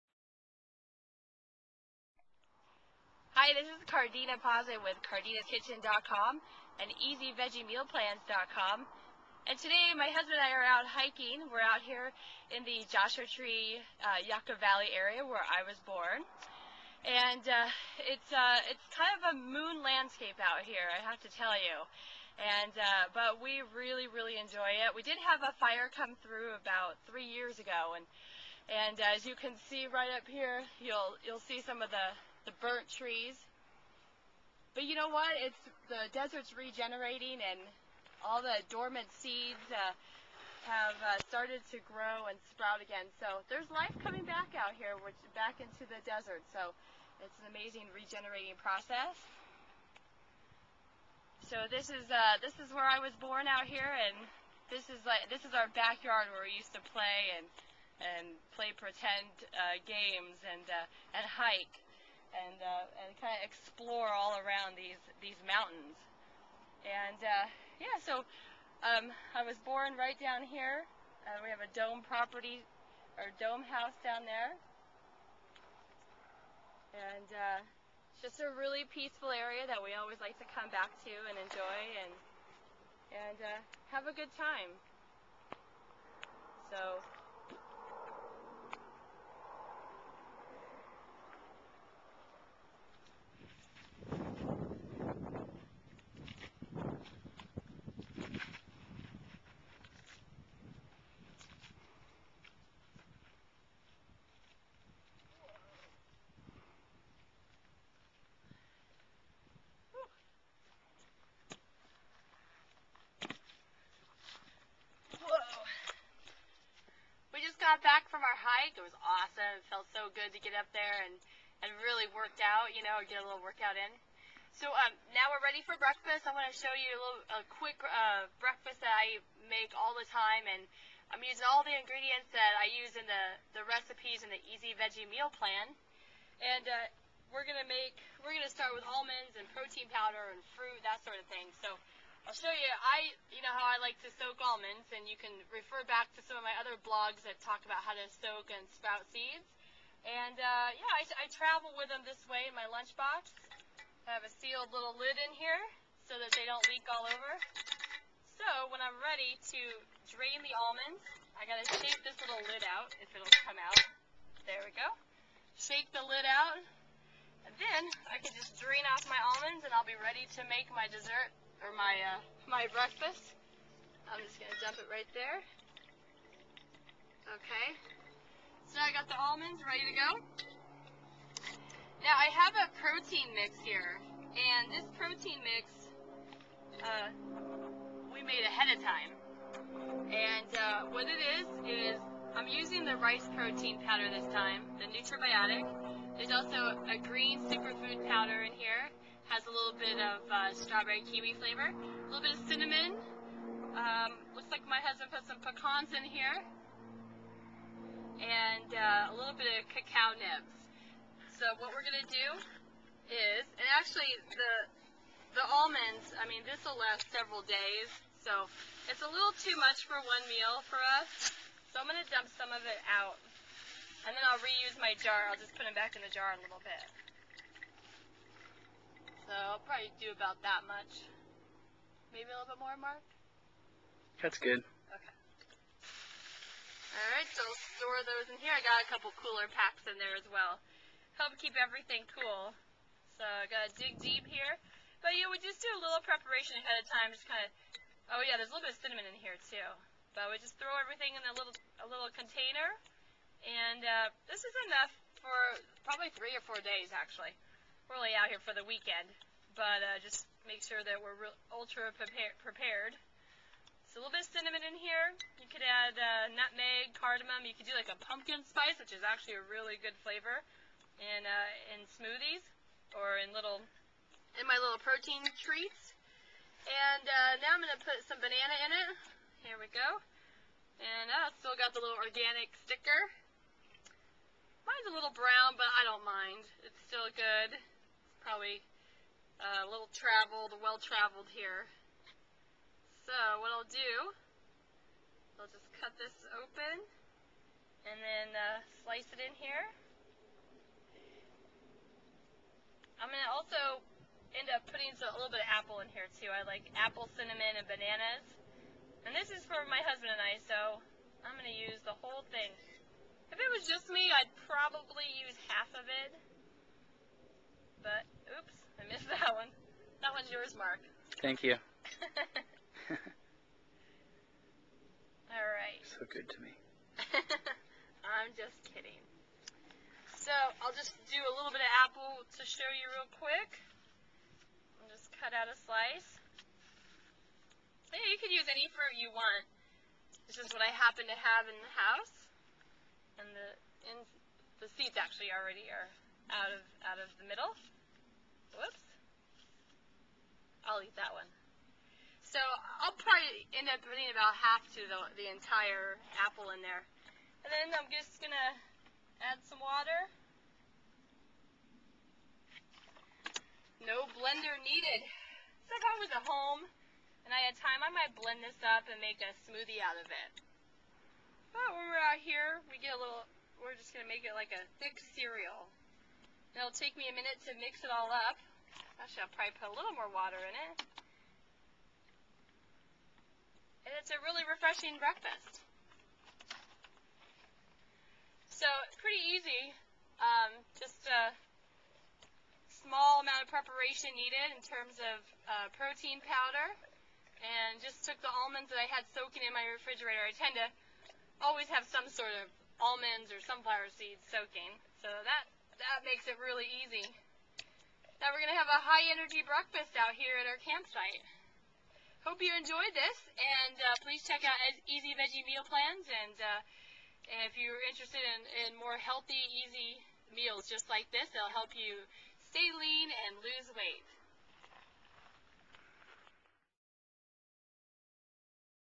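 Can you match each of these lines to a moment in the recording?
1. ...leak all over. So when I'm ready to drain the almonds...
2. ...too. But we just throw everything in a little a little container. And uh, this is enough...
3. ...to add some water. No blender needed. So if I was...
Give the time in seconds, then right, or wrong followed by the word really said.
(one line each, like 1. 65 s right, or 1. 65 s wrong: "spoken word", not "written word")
1. 156 s right
2. 249 s right
3. 358 s right.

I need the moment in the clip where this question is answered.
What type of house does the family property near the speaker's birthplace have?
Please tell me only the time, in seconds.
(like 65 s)
73 s.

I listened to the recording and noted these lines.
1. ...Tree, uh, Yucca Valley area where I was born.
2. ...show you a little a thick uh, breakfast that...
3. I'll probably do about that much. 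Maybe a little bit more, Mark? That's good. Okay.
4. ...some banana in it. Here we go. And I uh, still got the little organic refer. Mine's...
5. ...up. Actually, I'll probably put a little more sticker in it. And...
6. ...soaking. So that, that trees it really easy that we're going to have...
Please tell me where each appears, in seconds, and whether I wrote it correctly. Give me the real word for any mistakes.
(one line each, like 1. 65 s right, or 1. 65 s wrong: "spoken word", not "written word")
1. 13 s right
2. 126 s wrong: "quick", not "thick"
3. 229 s right
4. 278 s wrong: "sticker", not "refer"
5. 378 s wrong: "water", not "sticker"
6. 404 s wrong: "makes", not "trees".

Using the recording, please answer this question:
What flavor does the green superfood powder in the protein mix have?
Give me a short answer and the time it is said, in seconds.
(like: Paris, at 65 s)
Strawberry kiwi, at 200 s.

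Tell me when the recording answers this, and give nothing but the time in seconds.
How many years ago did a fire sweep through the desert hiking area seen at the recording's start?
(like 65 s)
27 s.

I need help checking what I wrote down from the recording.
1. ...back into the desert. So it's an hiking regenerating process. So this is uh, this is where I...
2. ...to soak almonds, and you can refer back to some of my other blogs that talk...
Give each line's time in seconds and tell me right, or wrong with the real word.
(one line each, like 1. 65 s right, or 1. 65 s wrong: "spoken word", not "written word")
1. 45 s wrong: "amazing", not "hiking"
2. 144 s right.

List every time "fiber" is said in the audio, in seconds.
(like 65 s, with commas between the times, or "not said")
not said.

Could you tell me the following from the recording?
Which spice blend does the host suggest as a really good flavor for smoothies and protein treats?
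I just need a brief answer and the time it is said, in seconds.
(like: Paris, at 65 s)
Pumpkin spice, at 267 s.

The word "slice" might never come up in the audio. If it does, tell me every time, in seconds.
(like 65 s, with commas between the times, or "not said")
298 s, 335 s.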